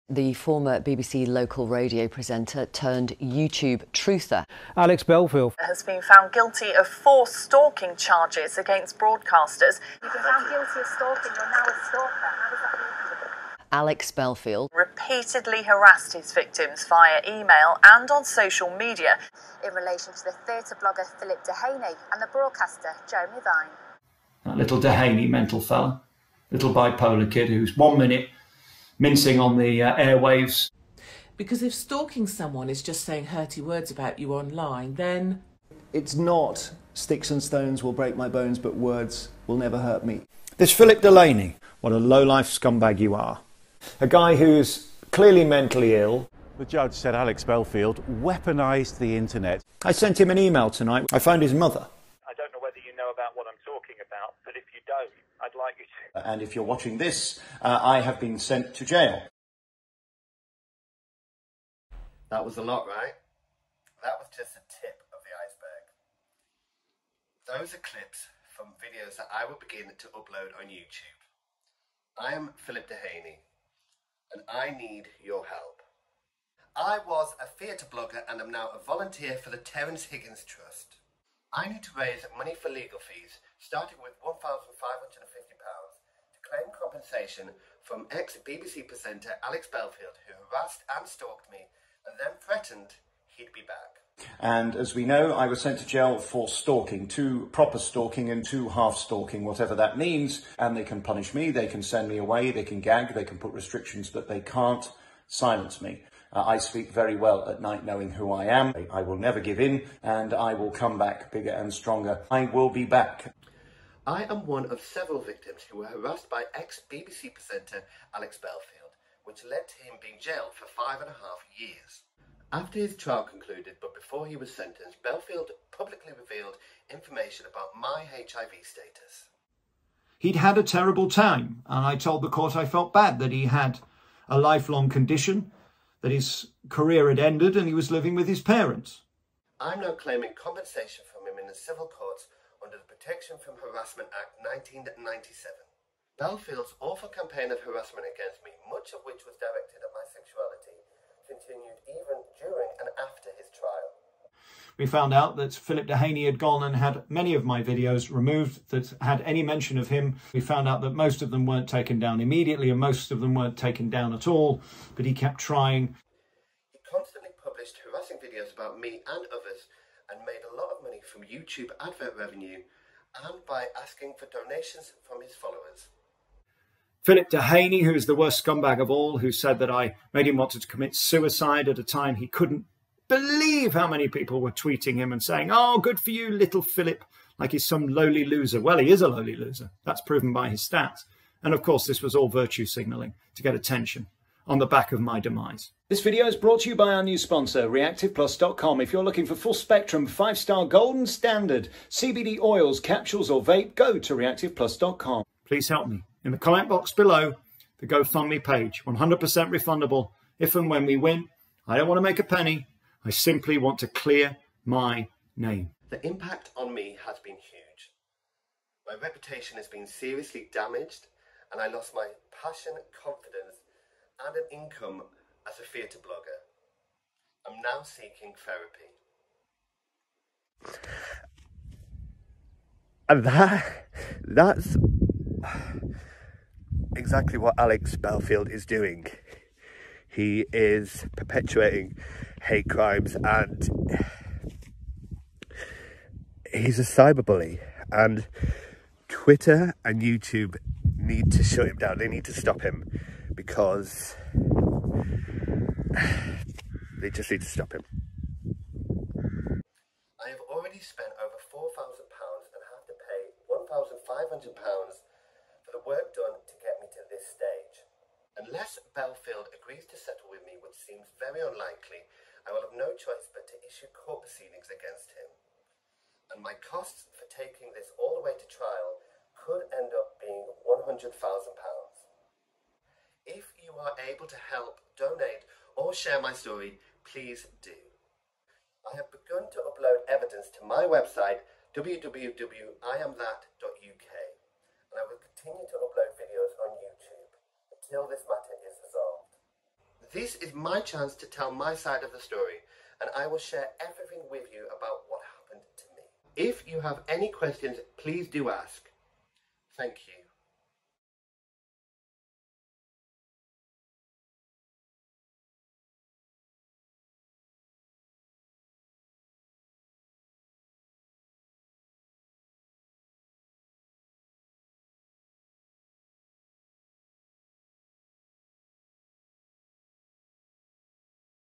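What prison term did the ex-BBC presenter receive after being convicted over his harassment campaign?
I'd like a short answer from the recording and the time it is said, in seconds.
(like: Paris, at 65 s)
5 and a half years, at 120 s.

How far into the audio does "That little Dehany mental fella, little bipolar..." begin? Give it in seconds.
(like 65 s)
24 s.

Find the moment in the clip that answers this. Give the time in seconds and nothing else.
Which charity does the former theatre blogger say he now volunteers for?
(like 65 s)
79 s.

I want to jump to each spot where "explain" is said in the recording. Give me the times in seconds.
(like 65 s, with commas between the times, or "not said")
not said.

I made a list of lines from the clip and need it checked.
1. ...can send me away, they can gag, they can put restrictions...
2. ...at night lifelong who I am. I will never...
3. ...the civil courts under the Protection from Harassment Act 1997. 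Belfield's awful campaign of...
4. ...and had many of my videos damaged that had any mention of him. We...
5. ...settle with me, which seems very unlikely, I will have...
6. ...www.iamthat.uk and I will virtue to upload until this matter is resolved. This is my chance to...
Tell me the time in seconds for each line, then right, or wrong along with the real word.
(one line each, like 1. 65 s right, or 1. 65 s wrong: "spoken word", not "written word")
1. 101 s right
2. 107 s wrong: "knowing", not "lifelong"
3. 141 s right
4. 156 s wrong: "removed", not "damaged"
5. 270 s right
6. 291 s wrong: "continue", not "virtue".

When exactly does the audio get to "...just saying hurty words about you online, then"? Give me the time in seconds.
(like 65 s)
32 s.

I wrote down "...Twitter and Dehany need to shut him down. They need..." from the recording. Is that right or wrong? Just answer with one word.
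wrong.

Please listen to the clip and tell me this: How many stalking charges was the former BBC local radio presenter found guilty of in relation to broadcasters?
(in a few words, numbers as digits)
4.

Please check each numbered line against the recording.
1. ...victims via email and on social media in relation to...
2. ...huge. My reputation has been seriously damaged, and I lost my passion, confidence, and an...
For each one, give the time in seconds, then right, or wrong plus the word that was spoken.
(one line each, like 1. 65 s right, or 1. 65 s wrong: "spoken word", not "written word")
1. 16 s right
2. 217 s right.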